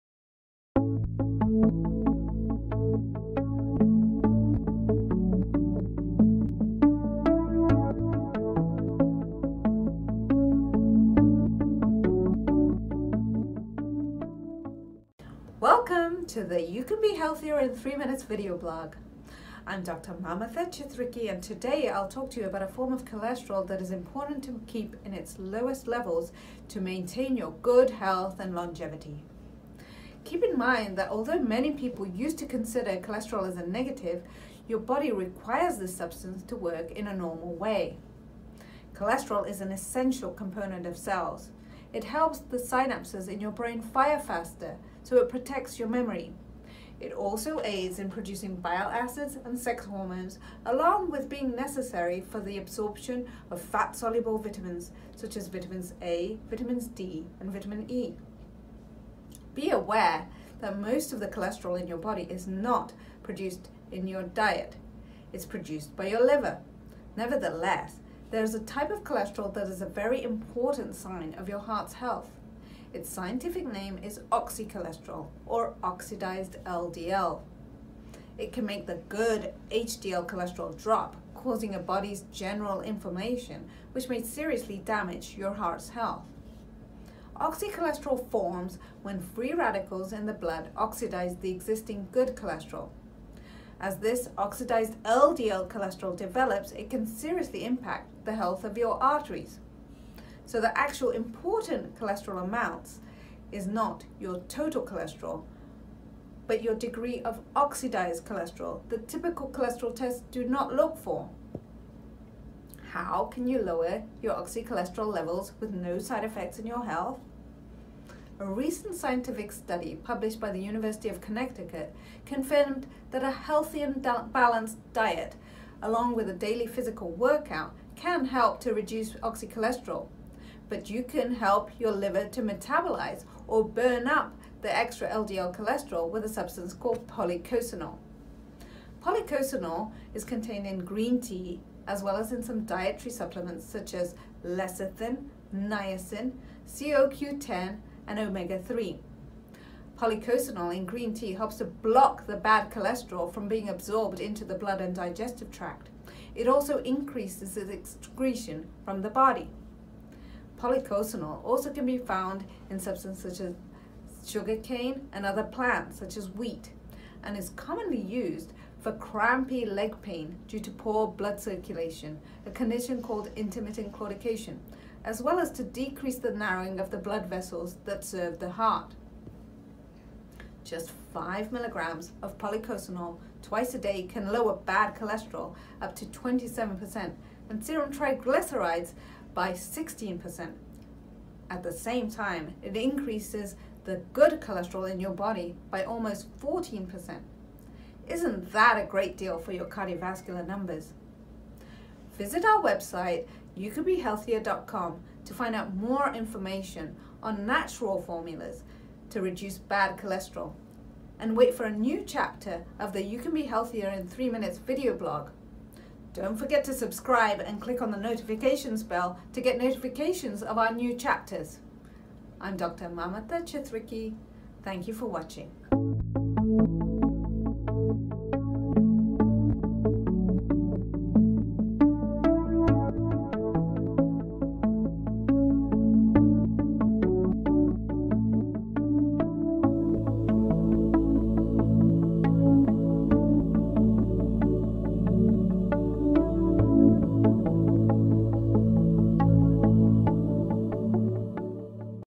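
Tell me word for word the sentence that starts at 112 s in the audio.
How can you lower your oxycholesterol levels with no side effects in your health?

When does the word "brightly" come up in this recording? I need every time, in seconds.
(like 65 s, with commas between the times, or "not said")
not said.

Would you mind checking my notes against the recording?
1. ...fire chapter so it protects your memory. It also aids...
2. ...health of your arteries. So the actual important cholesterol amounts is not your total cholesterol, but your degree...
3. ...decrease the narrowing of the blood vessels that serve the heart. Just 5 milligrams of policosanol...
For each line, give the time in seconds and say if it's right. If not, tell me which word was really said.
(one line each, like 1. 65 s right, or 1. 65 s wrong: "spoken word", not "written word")
1. 43 s wrong: "faster", not "chapter"
2. 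98 s right
3. 175 s right.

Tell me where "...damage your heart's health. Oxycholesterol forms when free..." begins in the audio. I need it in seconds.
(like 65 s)
84 s.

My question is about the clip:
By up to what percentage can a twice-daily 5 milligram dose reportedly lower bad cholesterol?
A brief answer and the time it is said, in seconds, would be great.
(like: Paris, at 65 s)
27%, at 186 s.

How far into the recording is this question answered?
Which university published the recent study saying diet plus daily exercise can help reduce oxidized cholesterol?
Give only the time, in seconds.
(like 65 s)
120 s.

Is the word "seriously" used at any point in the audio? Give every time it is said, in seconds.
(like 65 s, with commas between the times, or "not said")
84 s, 97 s.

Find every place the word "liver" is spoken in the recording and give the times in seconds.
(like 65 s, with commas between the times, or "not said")
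66 s, 131 s.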